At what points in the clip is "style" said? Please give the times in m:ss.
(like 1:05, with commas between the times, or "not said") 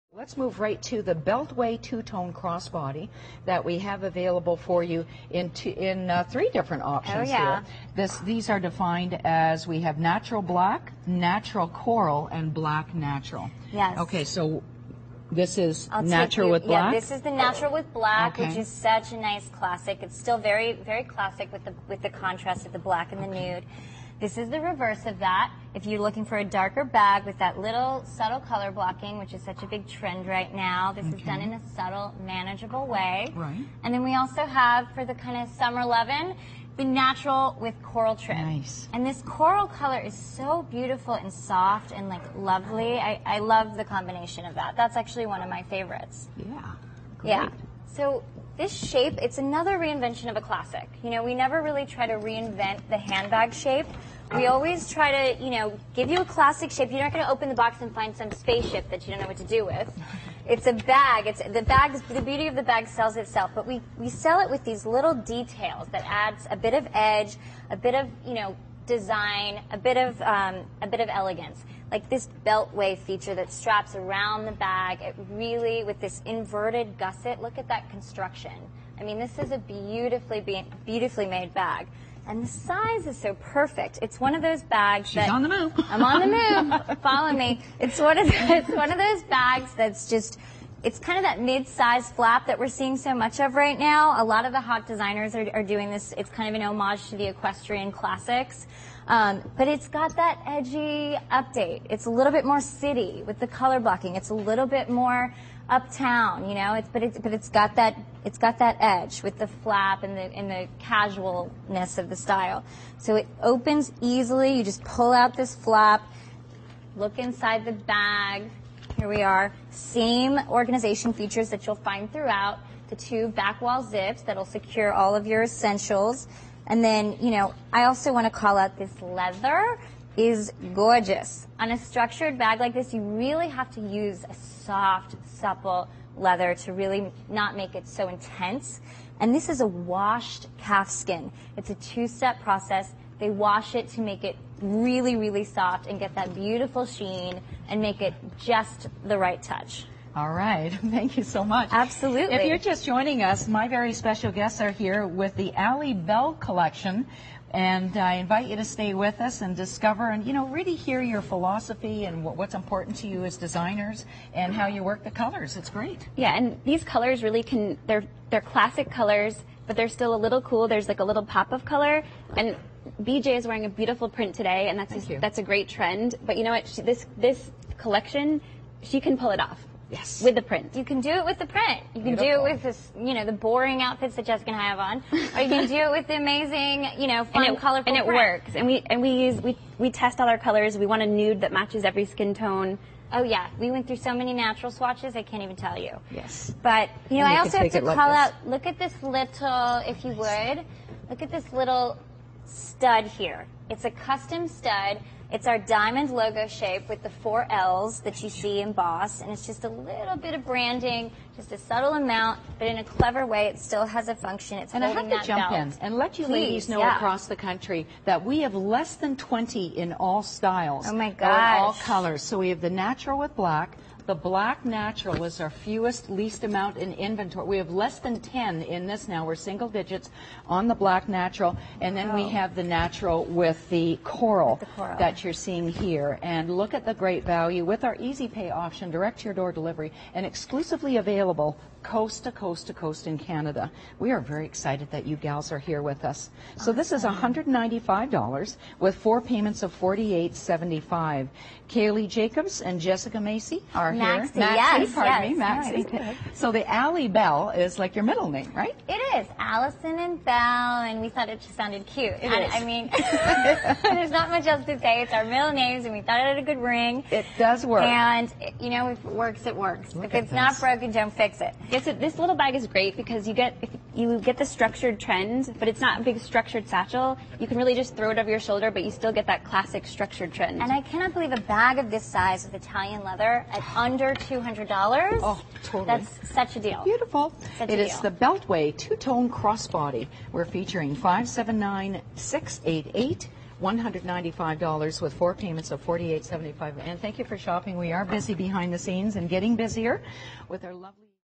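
1:52, 3:40.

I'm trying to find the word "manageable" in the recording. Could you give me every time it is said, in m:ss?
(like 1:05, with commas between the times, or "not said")
0:32.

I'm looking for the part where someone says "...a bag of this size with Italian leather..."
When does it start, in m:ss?
4:41.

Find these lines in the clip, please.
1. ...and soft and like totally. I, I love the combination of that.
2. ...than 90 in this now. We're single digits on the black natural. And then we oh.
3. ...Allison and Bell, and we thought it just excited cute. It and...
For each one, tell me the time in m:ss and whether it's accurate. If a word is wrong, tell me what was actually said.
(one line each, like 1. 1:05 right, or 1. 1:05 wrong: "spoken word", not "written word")
1. 0:41 wrong: "lovely", not "totally"
2. 3:47 wrong: "10", not "90"
3. 4:19 wrong: "sounded", not "excited".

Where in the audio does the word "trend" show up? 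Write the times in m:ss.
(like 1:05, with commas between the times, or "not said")
0:29, 2:55, 4:34, 4:40.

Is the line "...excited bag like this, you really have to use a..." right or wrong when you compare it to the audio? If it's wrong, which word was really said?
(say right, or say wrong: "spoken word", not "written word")
wrong: "structured", not "excited".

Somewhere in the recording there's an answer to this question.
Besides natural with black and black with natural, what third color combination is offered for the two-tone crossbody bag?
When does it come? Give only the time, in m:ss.
0:36.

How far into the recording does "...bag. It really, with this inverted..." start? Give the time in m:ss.
1:14.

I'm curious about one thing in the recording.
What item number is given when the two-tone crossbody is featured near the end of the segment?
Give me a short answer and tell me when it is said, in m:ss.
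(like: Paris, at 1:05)
579688, at 4:50.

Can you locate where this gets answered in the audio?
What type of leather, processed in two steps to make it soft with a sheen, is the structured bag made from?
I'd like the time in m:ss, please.
2:19.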